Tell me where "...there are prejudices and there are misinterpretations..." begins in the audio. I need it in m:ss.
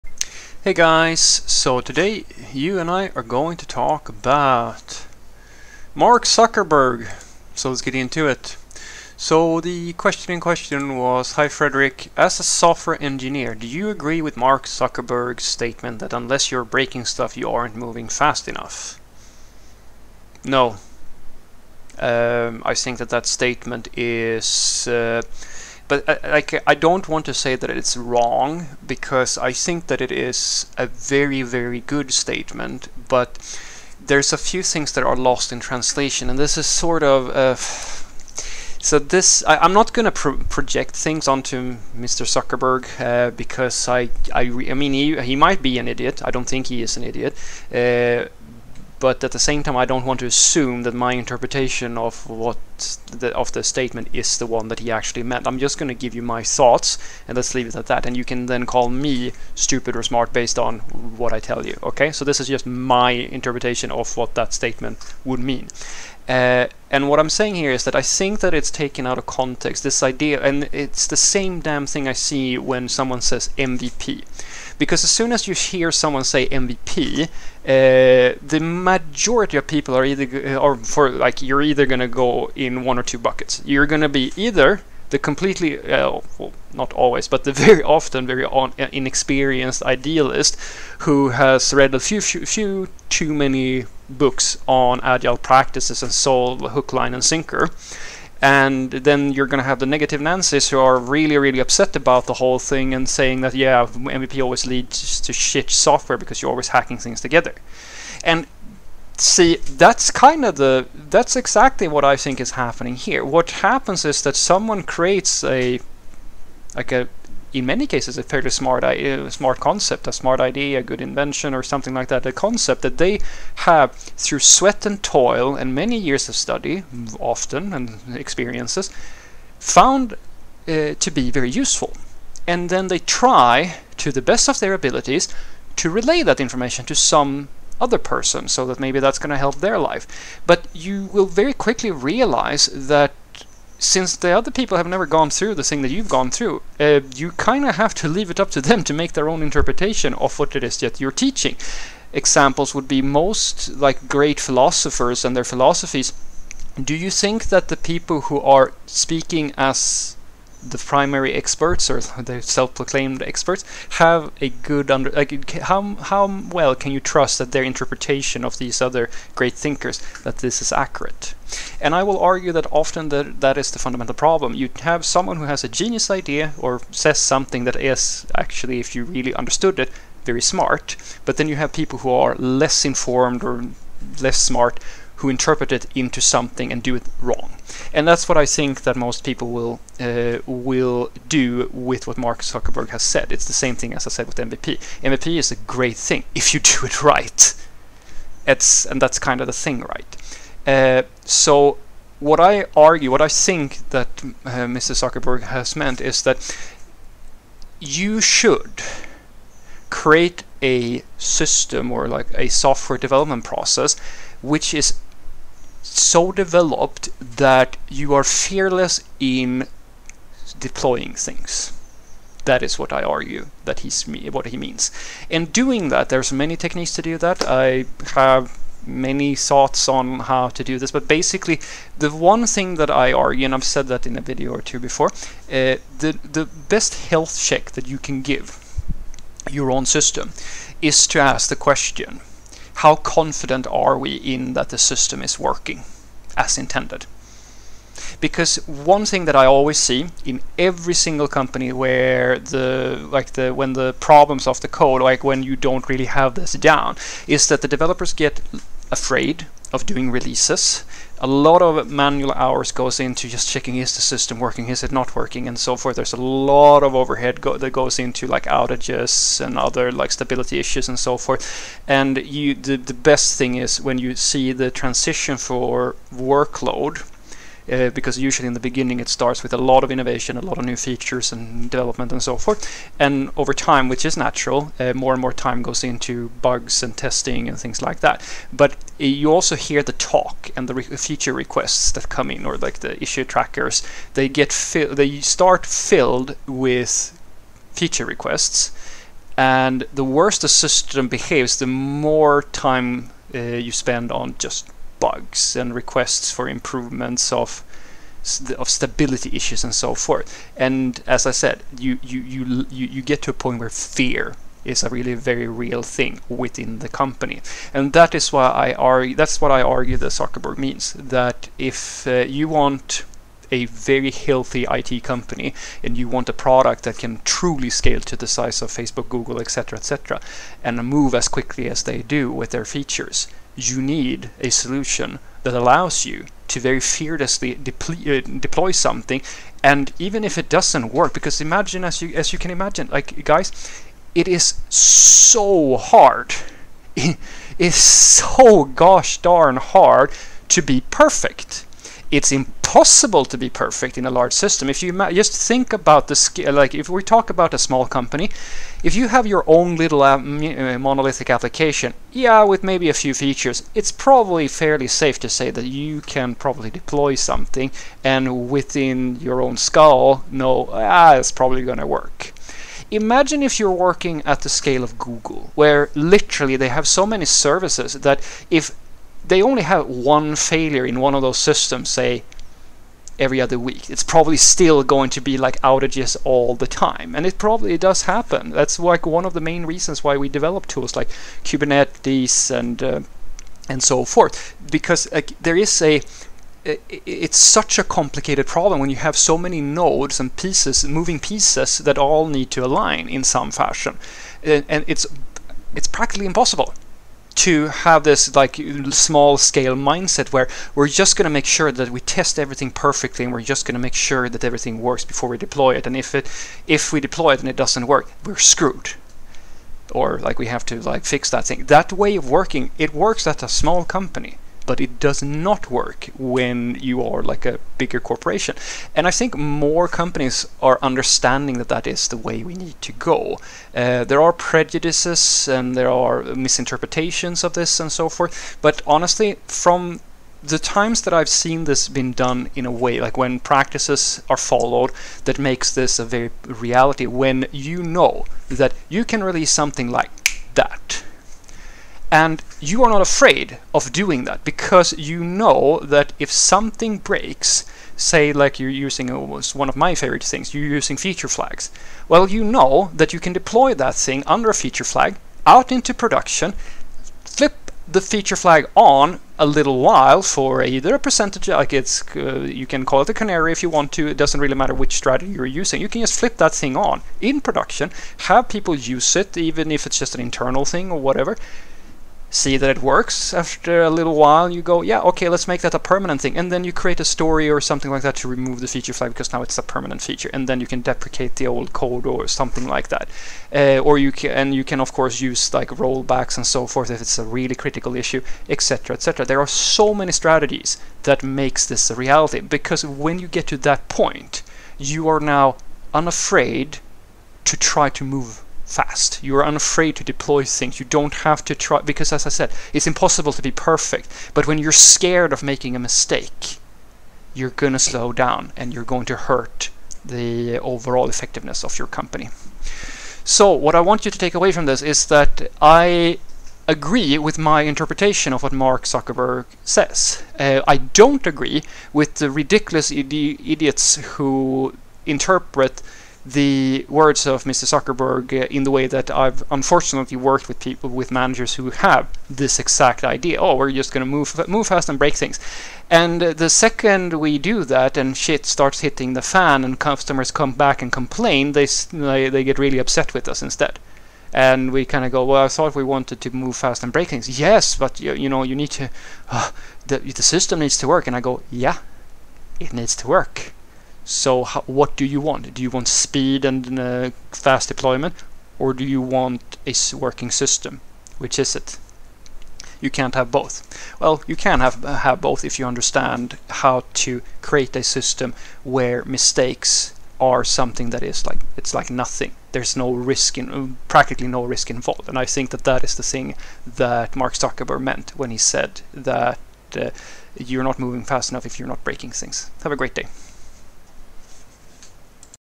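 7:14.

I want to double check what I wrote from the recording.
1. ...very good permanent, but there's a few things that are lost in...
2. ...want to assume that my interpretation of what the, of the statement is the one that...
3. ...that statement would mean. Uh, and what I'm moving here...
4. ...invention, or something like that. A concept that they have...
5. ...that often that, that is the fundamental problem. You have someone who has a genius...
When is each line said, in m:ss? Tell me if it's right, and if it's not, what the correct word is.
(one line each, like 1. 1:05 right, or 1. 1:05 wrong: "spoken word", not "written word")
1. 0:31 wrong: "statement", not "permanent"
2. 0:50 right
3. 1:04 wrong: "saying", not "moving"
4. 2:01 right
5. 2:52 right.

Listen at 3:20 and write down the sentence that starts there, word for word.
Uh, so what I argue, what I think that uh, Mr.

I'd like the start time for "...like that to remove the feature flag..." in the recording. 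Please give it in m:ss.
8:07.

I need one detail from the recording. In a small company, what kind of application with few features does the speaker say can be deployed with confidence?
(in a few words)
Monolithic application.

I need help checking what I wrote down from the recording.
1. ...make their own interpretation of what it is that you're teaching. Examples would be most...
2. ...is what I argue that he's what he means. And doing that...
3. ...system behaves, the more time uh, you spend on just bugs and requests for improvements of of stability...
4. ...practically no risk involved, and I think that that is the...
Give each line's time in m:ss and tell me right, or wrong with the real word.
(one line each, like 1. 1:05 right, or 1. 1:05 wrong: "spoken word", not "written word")
1. 2:28 right
2. 3:42 right
3. 5:00 right
4. 9:43 right.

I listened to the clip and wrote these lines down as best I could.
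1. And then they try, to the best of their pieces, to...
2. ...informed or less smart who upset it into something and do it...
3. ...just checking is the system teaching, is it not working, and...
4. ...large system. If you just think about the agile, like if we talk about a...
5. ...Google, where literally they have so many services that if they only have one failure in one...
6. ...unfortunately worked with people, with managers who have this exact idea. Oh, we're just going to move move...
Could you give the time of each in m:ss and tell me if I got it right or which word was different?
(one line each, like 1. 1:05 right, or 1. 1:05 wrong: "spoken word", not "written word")
1. 2:12 wrong: "abilities", not "pieces"
2. 3:02 wrong: "interpret", not "upset"
3. 4:23 wrong: "working", not "teaching"
4. 5:54 wrong: "scale", not "agile"
5. 6:14 right
6. 8:59 right.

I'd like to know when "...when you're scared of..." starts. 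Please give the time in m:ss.
8:34.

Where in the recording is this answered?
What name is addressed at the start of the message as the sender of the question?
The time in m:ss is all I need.
0:11.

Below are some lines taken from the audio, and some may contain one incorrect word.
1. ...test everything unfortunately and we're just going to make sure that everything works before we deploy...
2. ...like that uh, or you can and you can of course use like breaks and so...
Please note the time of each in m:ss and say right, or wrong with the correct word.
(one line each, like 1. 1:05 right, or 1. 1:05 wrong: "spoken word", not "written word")
1. 6:52 wrong: "perfectly", not "unfortunately"
2. 8:12 wrong: "rollbacks", not "breaks".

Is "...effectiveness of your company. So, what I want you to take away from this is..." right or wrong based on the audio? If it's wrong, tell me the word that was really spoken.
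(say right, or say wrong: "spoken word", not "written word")
right.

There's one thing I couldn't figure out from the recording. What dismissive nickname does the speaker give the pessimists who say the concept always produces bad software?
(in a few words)
Negative Nancy's.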